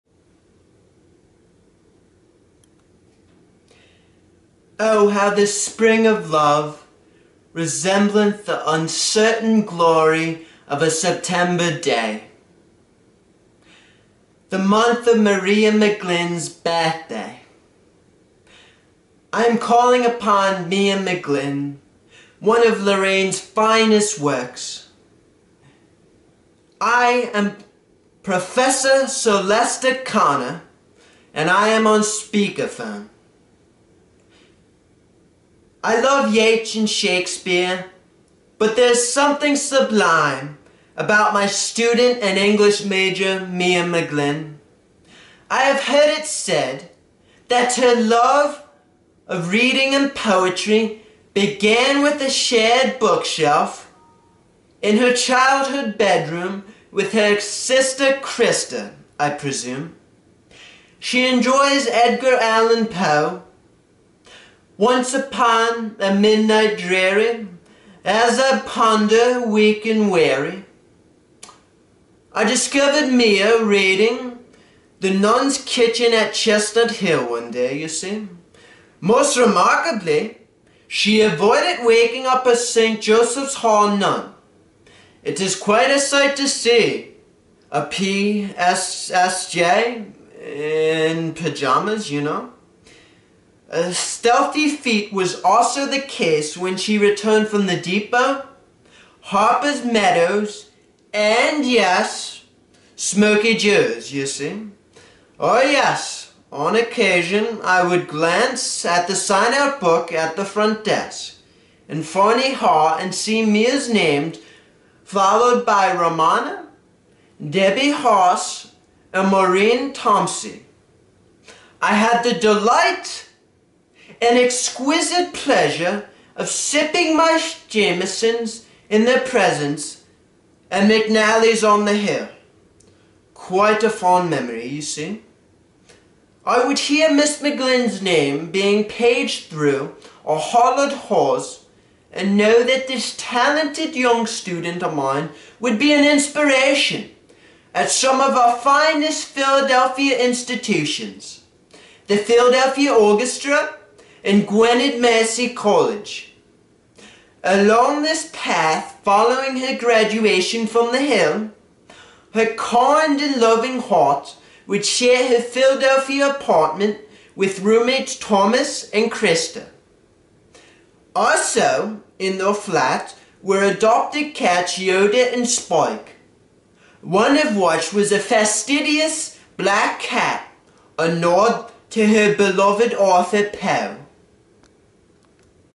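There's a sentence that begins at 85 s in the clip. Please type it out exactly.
It is quite a sight to see a PSSJ in pajamas, you know.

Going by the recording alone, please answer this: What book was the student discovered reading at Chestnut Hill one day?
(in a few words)
The Nun's Kitchen.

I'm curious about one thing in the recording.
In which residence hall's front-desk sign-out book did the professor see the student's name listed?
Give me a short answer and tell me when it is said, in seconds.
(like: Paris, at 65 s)
Fournier Hall, at 112 s.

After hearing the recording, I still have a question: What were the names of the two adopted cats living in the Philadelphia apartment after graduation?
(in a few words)
Yoda and Spike.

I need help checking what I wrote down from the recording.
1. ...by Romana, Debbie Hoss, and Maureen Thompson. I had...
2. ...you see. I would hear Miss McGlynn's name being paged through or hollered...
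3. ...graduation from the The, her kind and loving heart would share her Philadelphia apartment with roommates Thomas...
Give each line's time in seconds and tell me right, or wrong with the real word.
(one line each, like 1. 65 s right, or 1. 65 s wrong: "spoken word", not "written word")
1. 115 s right
2. 134 s right
3. 159 s wrong: "Hill", not "The".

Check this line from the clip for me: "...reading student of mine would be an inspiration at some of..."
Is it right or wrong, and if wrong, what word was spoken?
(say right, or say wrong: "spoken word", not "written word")
wrong: "young", not "reading".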